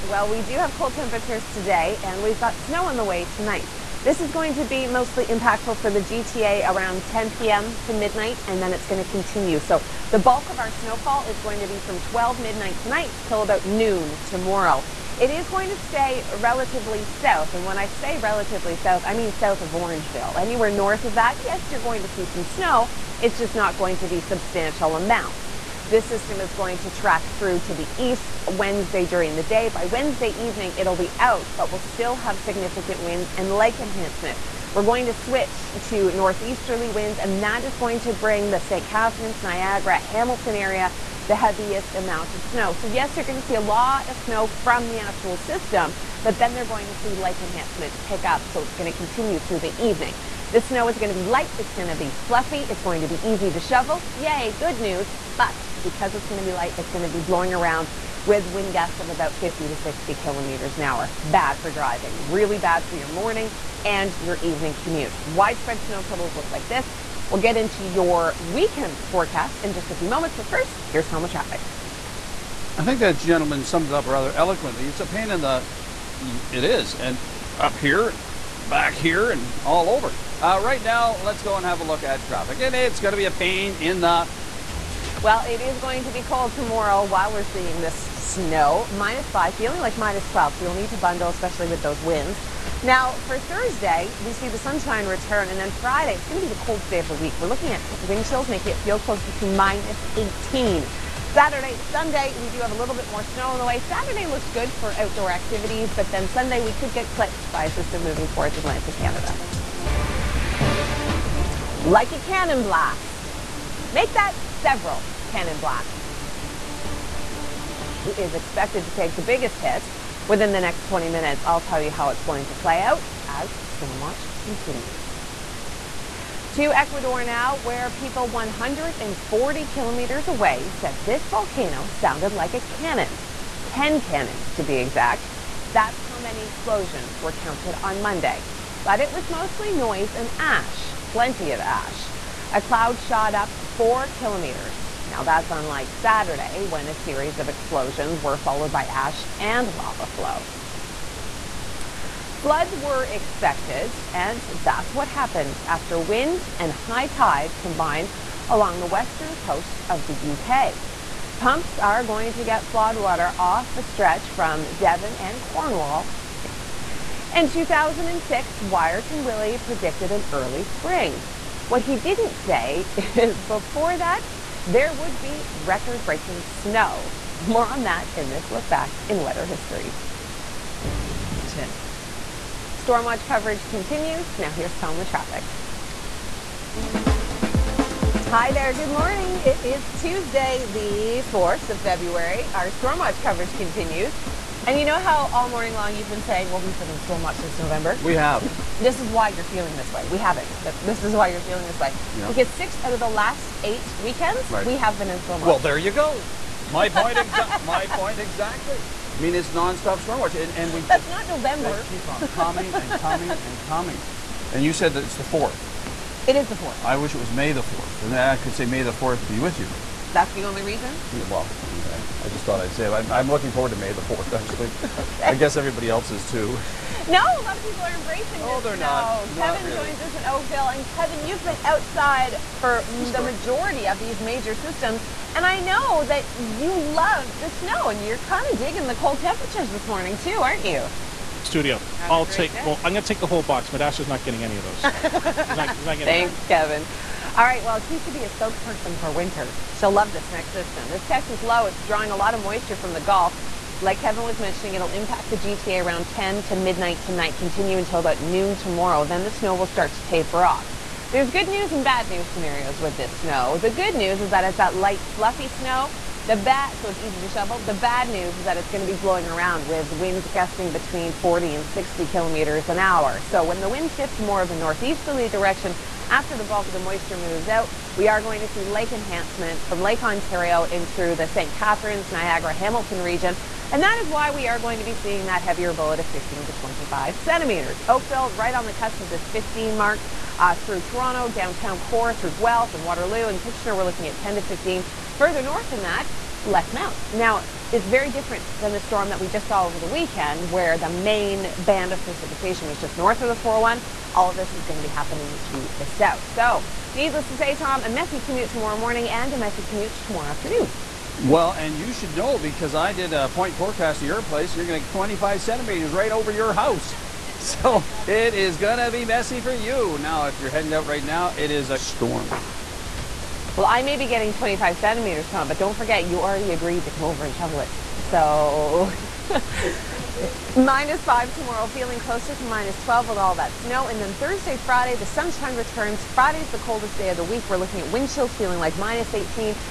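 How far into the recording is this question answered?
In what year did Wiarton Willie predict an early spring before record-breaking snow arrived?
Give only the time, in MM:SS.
02:47.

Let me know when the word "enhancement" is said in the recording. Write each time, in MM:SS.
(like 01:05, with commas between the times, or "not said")
00:33, 00:47, 04:38.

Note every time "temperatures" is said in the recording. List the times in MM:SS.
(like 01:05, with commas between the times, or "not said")
00:00, 03:59.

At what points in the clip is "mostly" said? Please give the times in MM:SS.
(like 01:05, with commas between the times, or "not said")
00:04, 02:19.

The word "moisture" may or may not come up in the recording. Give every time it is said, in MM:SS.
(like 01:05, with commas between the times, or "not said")
04:12, 04:36.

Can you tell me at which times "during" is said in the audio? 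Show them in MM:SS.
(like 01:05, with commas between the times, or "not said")
00:29.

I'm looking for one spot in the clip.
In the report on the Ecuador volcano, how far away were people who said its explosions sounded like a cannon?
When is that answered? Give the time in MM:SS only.
02:08.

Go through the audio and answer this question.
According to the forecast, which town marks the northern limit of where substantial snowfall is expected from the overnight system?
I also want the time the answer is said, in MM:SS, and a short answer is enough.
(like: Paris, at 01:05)
Orangeville, at 00:19.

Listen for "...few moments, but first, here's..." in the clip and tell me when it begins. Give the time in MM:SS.
01:09.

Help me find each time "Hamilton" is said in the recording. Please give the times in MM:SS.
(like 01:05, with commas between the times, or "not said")
00:39, 04:42.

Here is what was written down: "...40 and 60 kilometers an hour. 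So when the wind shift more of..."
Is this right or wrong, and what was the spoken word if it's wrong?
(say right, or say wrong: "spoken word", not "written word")
right.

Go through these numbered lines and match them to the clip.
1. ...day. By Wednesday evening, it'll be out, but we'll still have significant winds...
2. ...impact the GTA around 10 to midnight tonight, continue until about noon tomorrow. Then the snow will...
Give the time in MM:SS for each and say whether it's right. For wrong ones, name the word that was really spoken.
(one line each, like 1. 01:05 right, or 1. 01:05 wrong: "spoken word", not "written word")
1. 00:29 right
2. 04:14 right.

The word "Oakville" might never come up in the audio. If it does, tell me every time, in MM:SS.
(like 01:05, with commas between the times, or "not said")
03:50, 04:47.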